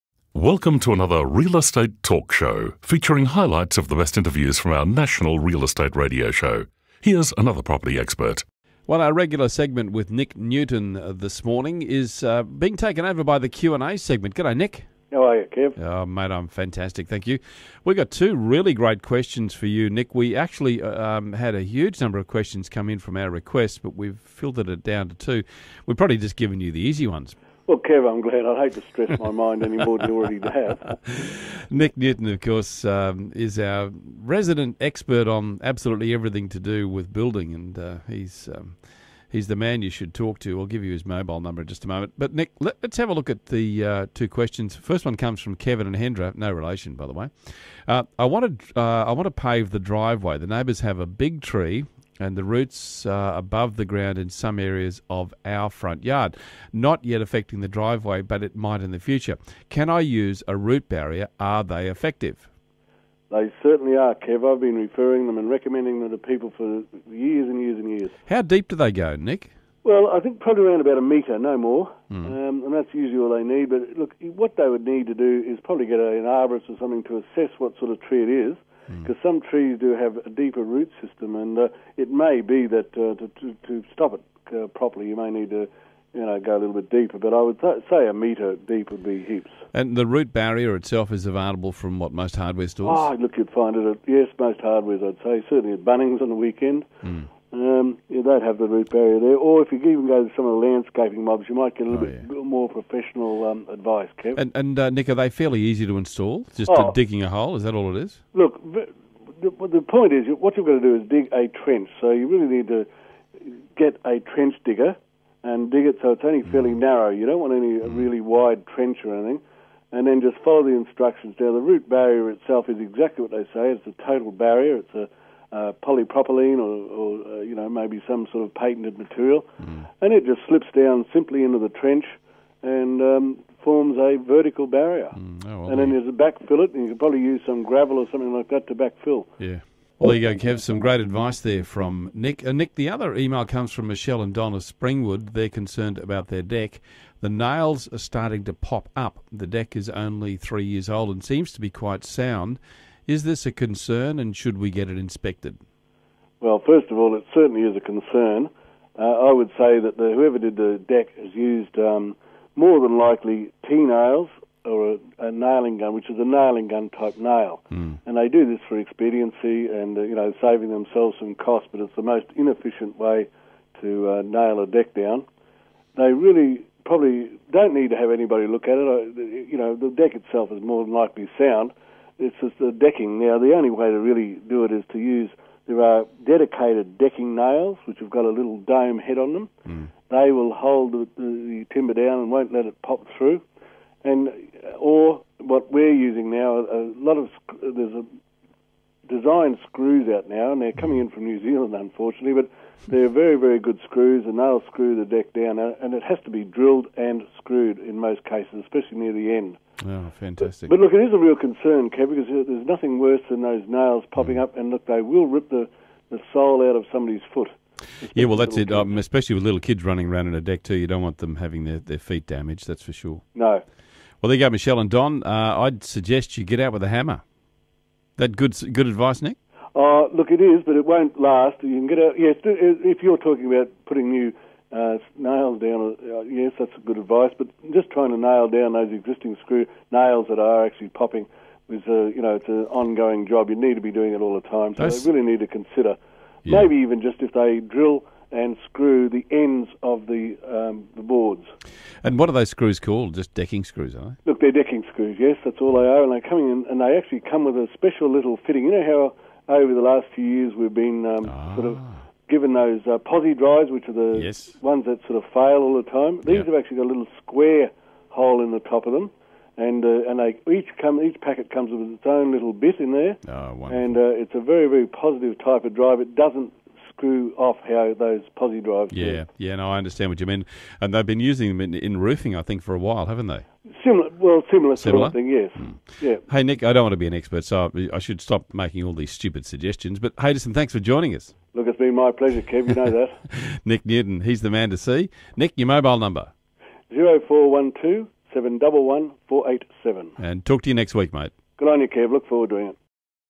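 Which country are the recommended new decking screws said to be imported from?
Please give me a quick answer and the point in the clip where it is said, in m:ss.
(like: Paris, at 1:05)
New Zealand, at 3:21.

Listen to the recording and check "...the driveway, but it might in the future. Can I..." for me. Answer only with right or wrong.
right.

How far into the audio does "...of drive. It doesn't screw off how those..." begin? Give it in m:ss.
4:35.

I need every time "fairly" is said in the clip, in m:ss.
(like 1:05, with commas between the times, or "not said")
1:45, 1:56.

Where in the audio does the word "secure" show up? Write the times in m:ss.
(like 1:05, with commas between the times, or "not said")
not said.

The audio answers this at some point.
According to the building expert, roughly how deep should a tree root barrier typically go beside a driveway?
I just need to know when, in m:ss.
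1:10.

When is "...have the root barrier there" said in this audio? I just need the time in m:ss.
1:38.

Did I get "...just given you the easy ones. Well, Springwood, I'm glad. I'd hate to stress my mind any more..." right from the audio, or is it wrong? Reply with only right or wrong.
wrong.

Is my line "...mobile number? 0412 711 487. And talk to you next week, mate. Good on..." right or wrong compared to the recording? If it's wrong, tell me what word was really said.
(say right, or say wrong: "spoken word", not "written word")
right.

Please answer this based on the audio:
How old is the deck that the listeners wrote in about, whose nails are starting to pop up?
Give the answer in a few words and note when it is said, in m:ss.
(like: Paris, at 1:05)
3 years, at 2:30.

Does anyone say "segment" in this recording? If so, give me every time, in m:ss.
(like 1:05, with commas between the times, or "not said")
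0:09, 0:13.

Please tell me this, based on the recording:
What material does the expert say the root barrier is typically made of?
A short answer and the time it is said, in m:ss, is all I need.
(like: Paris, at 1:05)
polypropylene, at 2:05.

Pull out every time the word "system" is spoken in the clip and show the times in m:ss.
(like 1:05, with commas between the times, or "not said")
1:21.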